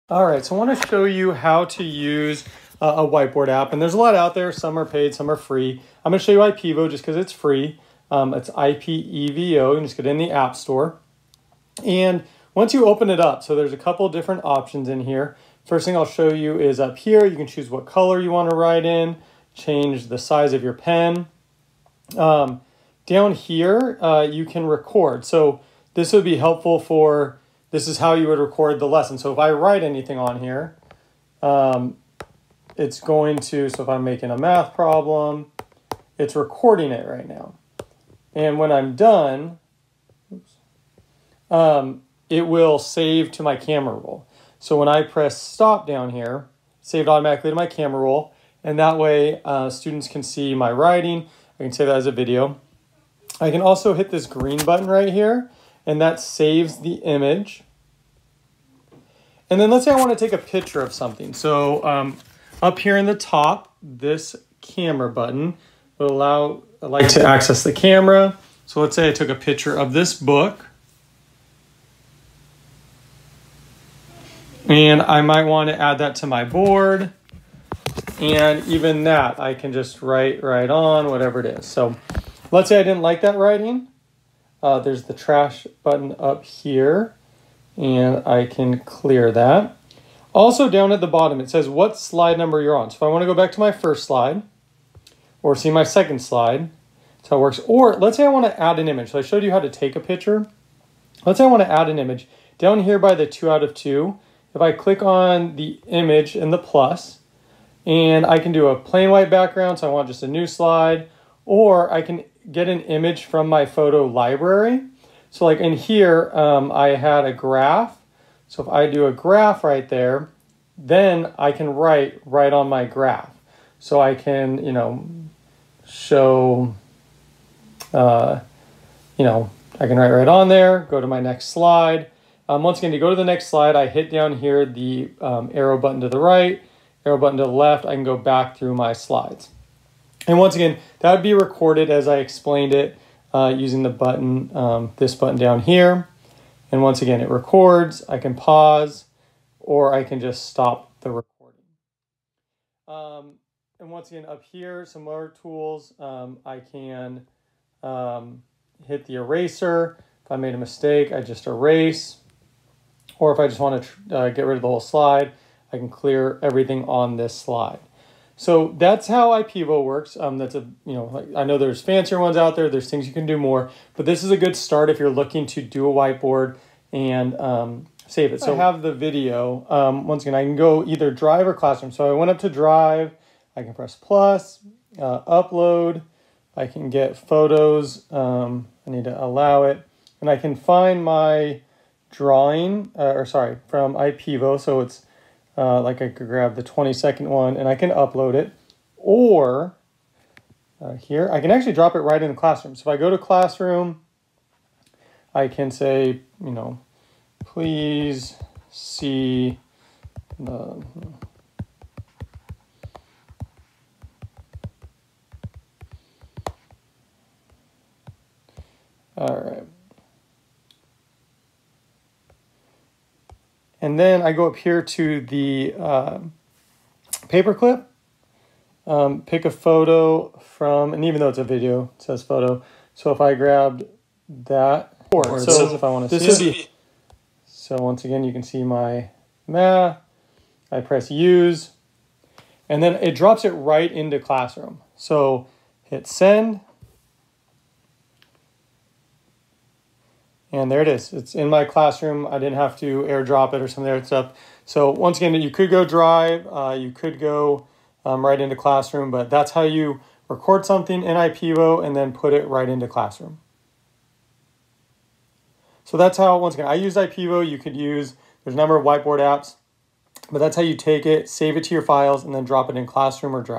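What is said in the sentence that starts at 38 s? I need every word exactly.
And when I'm done, oops, um, it will save to my camera roll.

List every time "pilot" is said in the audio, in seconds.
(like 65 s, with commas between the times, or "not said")
not said.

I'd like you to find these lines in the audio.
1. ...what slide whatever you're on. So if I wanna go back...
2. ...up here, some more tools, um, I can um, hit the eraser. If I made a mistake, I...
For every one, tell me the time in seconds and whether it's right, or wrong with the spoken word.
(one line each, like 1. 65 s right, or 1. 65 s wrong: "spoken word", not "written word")
1. 91 s wrong: "number", not "whatever"
2. 154 s right.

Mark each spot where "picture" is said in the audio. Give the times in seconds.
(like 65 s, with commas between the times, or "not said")
60 s, 69 s, 99 s.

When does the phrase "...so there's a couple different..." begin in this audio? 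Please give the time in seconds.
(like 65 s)
13 s.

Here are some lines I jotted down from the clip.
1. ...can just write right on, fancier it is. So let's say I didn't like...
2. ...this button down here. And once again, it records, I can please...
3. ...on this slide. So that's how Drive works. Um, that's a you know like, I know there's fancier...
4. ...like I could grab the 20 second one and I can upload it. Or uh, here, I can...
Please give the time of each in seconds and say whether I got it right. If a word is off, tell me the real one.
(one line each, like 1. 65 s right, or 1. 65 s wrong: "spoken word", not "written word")
1. 79 s wrong: "whatever", not "fancier"
2. 144 s wrong: "pause", not "please"
3. 166 s wrong: "IPEVO", not "Drive"
4. 195 s right.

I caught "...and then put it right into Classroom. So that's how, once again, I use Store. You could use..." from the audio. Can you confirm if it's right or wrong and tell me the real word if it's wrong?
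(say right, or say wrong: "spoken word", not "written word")
wrong: "IPEVO", not "Store".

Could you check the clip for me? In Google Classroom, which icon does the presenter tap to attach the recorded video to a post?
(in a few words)
Paperclip.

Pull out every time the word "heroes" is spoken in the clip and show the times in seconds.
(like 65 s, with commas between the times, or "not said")
not said.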